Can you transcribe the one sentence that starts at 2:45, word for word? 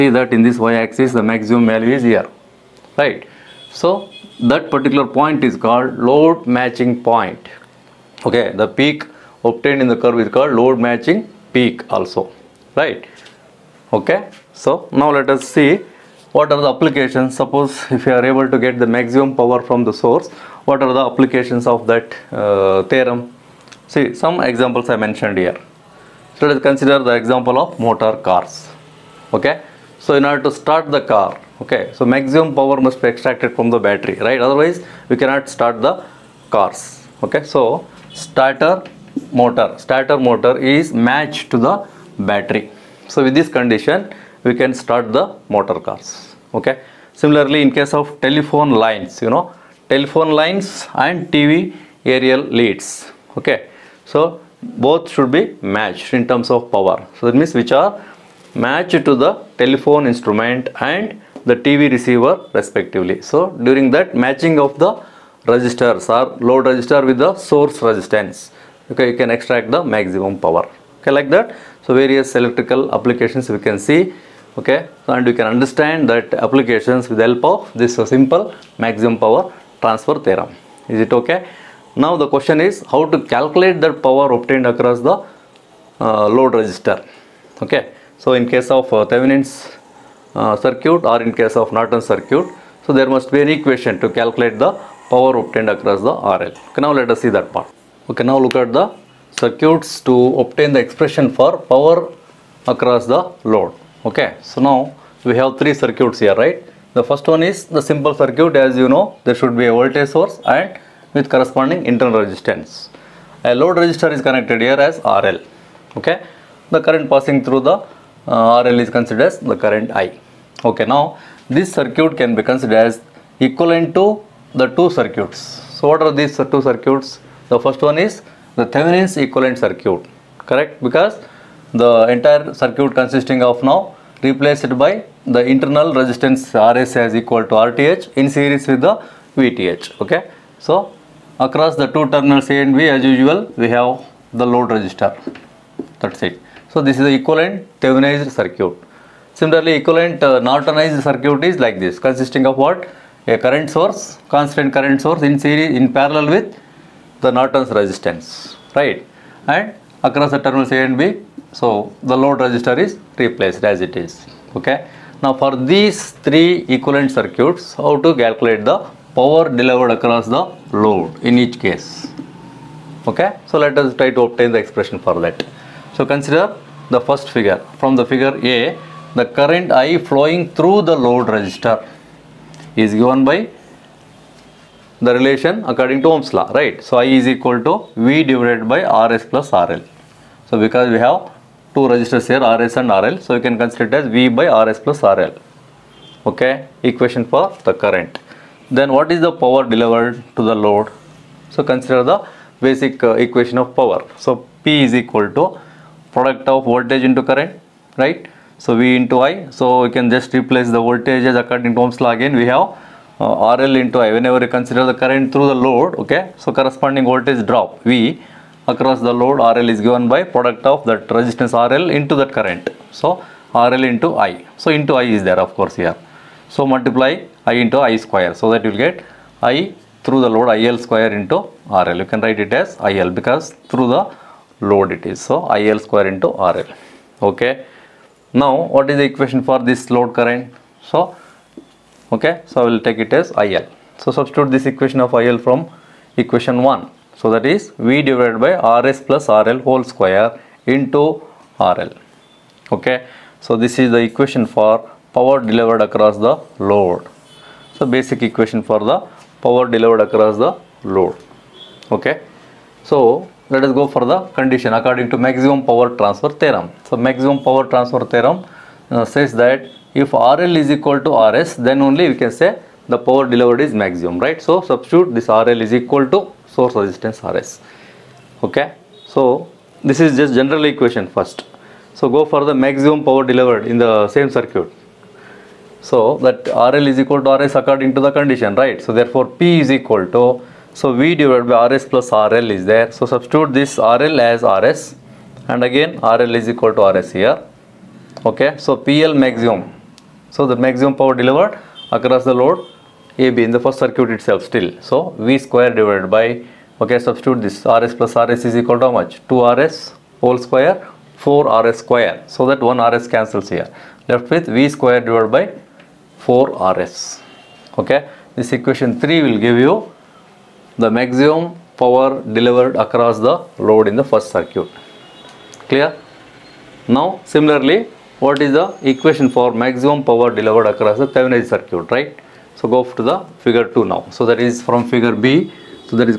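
Now for these three equivalent circuits, how to calculate the power delivered across the load in each case, okay?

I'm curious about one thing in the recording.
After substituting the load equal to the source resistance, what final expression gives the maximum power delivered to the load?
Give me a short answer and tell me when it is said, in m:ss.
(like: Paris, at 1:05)
V²/4RS, at 5:14.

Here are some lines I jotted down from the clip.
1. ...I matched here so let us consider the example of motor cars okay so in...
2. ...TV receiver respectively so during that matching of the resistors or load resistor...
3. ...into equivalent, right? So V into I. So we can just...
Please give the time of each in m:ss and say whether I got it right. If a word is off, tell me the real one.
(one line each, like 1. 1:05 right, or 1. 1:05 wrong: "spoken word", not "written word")
1. 0:24 wrong: "mentioned", not "matched"
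2. 1:01 right
3. 3:27 wrong: "current", not "equivalent".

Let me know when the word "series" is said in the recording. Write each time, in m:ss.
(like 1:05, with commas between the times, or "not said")
2:18, 2:35.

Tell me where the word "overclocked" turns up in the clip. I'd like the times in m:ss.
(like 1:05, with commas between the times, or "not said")
not said.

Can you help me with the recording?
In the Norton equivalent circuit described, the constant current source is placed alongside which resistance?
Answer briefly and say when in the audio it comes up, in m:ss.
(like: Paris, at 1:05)
Norton's resistance, at 2:37.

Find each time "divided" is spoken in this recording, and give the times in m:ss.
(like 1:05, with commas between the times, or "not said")
3:08, 4:08, 4:51, 5:05, 5:14.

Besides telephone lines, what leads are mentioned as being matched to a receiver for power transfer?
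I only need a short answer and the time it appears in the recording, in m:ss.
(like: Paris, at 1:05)
TV aerial leads, at 0:51.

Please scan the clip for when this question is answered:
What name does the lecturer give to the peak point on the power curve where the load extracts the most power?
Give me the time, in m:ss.
0:05.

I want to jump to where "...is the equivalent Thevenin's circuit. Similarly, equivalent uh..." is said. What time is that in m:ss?
2:26.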